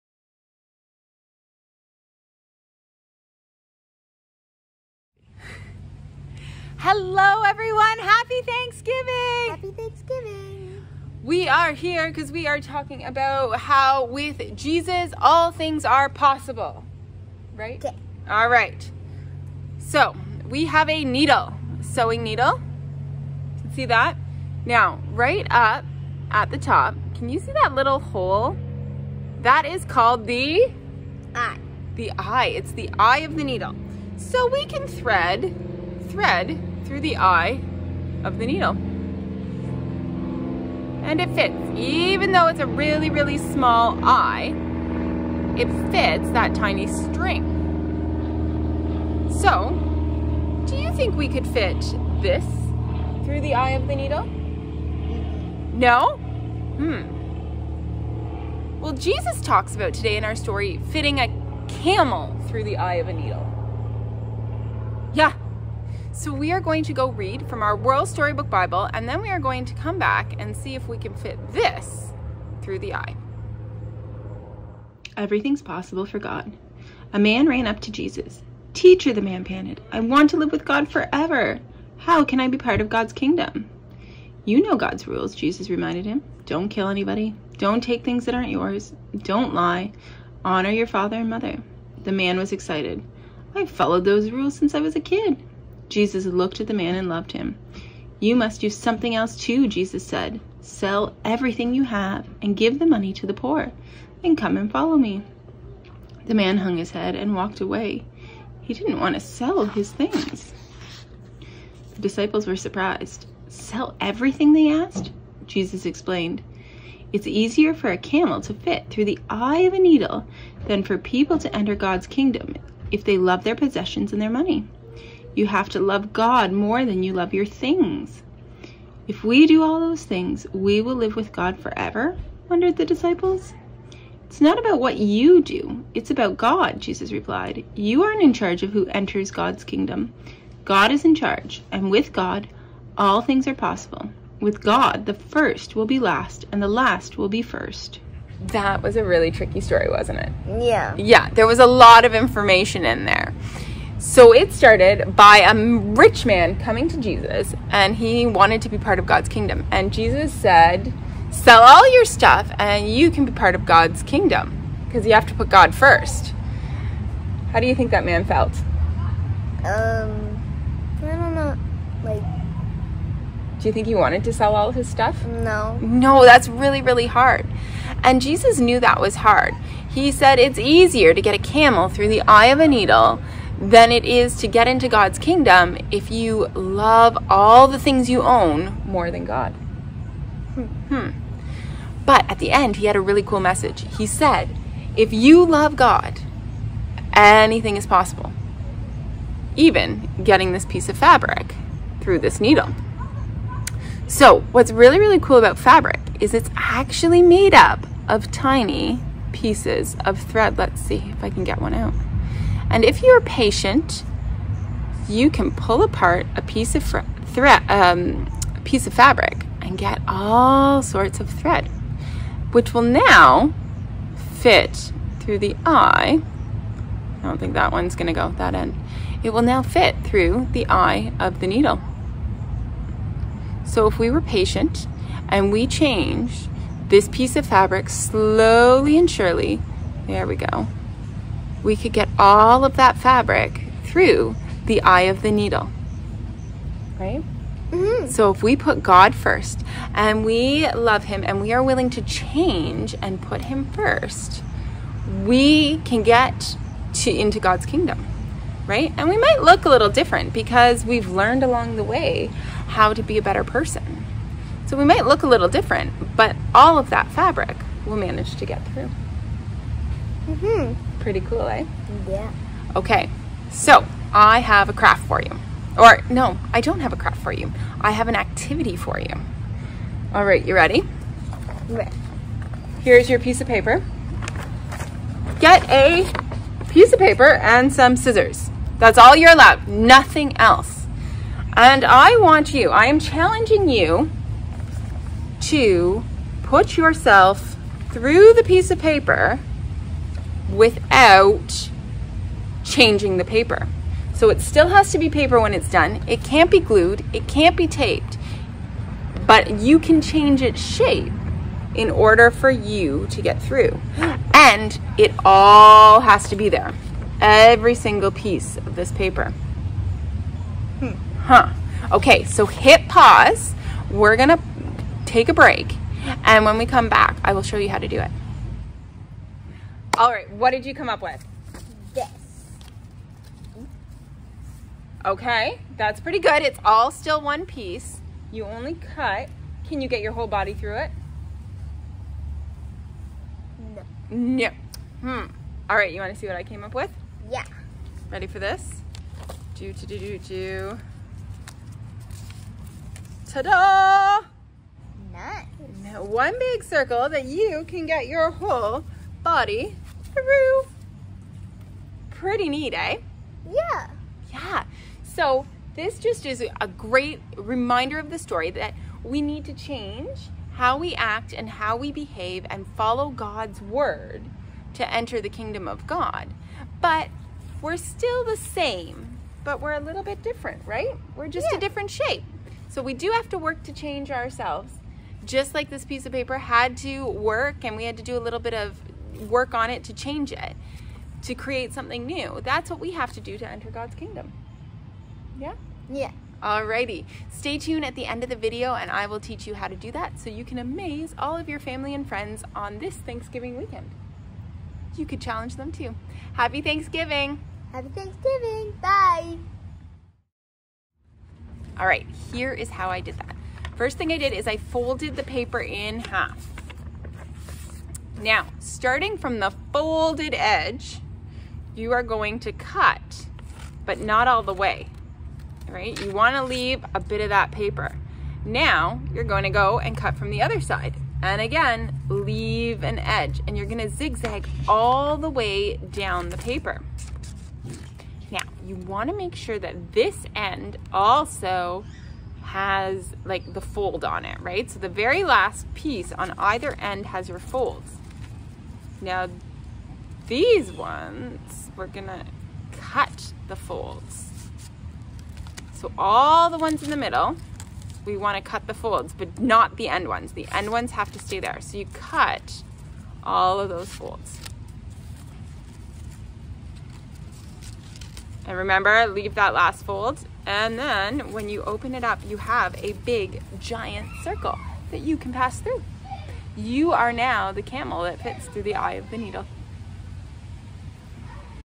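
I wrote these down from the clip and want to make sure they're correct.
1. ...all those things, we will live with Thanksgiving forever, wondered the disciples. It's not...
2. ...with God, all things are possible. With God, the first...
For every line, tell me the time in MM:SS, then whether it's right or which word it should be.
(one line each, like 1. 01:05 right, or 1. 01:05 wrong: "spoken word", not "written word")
1. 02:09 wrong: "God", not "Thanksgiving"
2. 02:21 right.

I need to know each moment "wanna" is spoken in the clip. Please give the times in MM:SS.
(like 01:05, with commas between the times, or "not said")
07:06, 07:18, 07:38.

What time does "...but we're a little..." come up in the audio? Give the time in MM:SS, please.
06:19.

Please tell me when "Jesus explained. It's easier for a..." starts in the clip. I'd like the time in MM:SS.
01:55.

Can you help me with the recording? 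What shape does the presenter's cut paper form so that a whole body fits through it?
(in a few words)
One big circle.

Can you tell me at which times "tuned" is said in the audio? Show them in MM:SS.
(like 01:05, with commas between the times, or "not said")
06:37.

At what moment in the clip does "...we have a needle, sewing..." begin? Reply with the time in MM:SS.
00:20.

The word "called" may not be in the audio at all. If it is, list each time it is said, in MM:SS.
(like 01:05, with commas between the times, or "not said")
00:29.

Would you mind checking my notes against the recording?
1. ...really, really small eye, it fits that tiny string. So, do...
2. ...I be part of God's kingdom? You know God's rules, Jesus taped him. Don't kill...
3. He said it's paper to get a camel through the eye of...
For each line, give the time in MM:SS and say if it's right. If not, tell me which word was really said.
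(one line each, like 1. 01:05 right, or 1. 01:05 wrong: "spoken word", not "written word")
1. 00:42 right
2. 01:22 wrong: "reminded", not "taped"
3. 02:59 wrong: "easier", not "paper".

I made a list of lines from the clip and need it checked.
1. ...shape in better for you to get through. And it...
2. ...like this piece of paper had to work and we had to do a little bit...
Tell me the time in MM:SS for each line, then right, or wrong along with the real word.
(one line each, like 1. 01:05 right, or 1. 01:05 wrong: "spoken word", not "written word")
1. 05:10 wrong: "order", not "better"
2. 06:25 right.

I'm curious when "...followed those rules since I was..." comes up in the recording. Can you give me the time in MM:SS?
01:33.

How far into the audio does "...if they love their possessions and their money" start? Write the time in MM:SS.
02:02.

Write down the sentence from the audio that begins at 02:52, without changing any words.
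Like, do you think he wanted to sell all his stuff?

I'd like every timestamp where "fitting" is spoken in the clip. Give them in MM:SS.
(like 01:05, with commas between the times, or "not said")
01:00.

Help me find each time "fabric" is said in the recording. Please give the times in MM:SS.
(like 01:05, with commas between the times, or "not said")
03:20, 03:25, 03:38, 03:57, 04:02, 04:27.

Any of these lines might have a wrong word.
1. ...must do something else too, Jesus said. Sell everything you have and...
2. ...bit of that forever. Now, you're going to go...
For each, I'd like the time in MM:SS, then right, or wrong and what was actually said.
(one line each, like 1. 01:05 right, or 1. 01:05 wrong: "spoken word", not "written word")
1. 01:38 right
2. 07:06 wrong: "paper", not "forever".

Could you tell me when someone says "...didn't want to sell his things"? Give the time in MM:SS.
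01:48.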